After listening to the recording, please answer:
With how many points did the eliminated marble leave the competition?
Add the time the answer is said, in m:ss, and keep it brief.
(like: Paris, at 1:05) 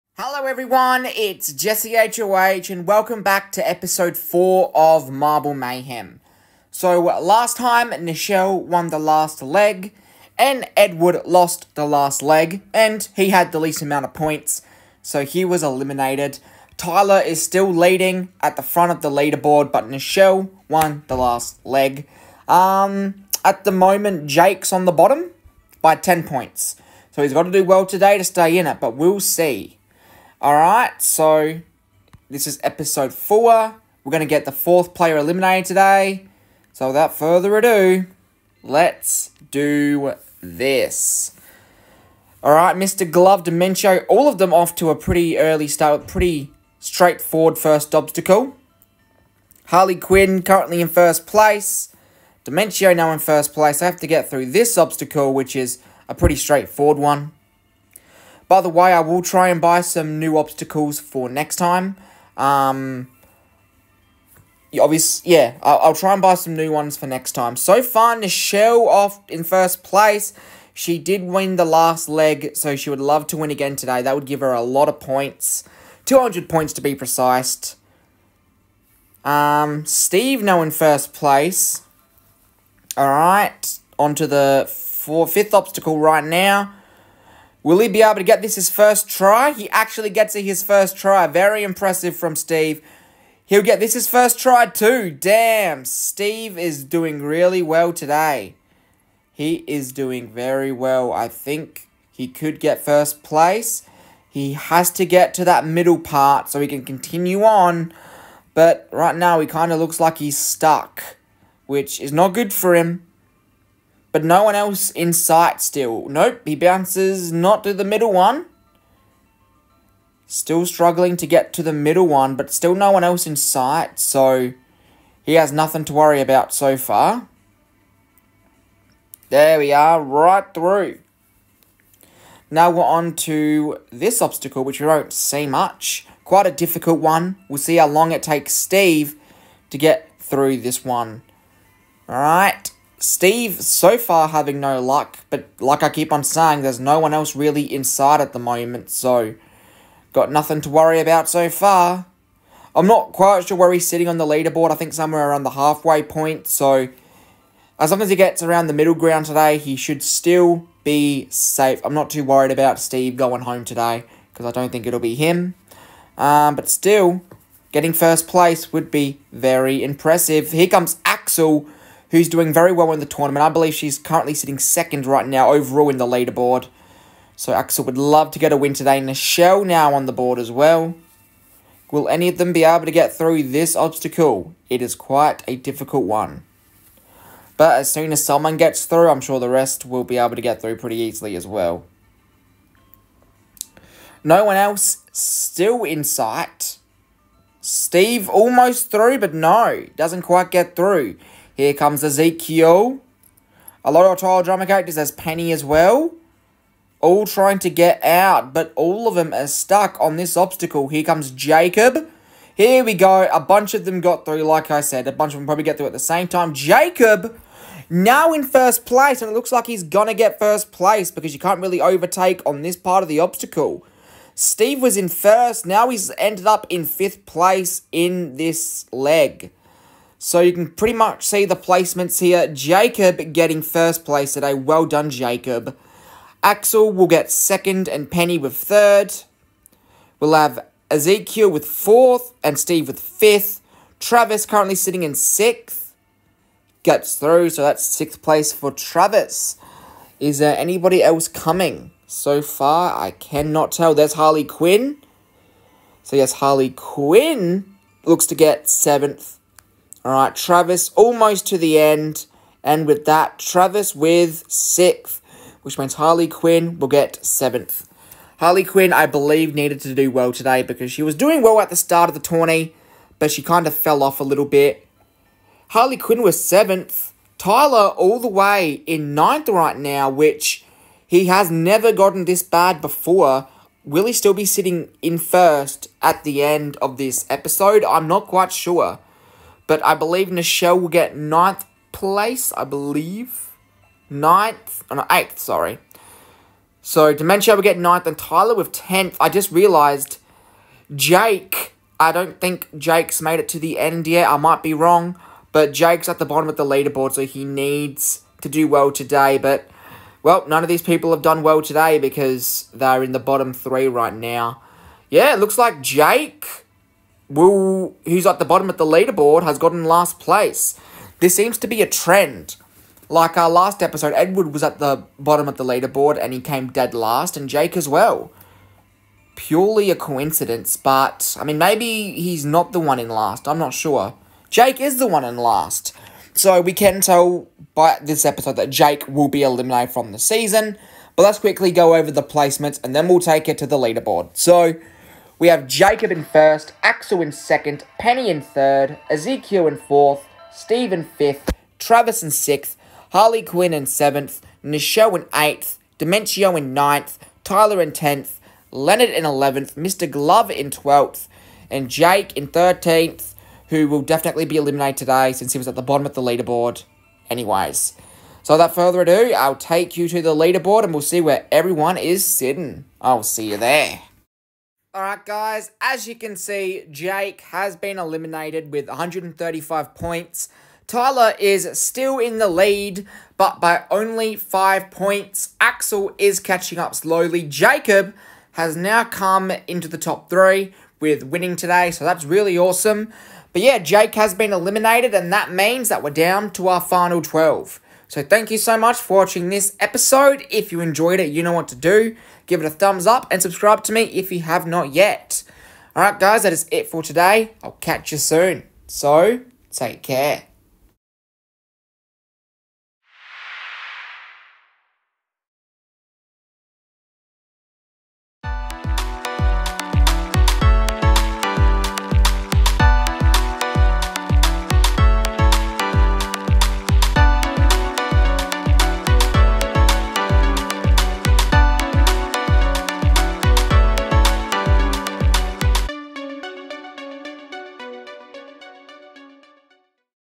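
135, at 6:18.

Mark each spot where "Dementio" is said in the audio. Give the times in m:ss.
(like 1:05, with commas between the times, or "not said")
0:43, 0:52, 4:57, 5:55.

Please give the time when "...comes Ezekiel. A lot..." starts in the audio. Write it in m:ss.
3:21.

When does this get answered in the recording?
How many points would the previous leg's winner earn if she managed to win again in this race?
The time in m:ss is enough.
1:16.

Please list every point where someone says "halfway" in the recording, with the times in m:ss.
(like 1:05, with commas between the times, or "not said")
2:35.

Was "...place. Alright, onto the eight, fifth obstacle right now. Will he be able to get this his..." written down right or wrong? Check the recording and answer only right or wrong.
wrong.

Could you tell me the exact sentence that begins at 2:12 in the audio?
Now we're on to this obstacle, which we don't see much.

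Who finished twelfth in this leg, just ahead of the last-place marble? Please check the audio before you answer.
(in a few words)
Mr. Glover.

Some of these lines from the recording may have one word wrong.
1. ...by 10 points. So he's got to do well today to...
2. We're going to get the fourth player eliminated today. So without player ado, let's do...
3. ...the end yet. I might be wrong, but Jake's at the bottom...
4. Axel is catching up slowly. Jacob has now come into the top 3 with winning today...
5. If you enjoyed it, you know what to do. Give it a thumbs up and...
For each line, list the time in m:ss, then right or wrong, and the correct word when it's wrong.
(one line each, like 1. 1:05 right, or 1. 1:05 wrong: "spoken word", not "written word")
1. 0:25 right
2. 0:34 wrong: "further", not "player"
3. 5:03 right
4. 6:25 right
5. 6:40 right.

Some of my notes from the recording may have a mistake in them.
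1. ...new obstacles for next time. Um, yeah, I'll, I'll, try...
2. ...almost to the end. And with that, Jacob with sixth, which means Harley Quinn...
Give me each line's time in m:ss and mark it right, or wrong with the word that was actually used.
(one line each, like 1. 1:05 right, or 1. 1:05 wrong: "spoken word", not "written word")
1. 1:00 right
2. 4:20 wrong: "Travis", not "Jacob".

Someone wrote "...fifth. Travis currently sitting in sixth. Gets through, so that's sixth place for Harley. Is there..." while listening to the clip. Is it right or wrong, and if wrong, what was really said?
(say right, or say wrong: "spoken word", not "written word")
wrong: "Travis", not "Harley".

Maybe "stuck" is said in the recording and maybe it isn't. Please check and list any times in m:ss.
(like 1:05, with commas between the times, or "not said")
1:50, 3:29.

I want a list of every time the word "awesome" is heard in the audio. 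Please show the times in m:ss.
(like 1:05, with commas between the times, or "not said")
6:32.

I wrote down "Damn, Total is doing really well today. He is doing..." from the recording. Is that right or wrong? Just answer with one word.
wrong.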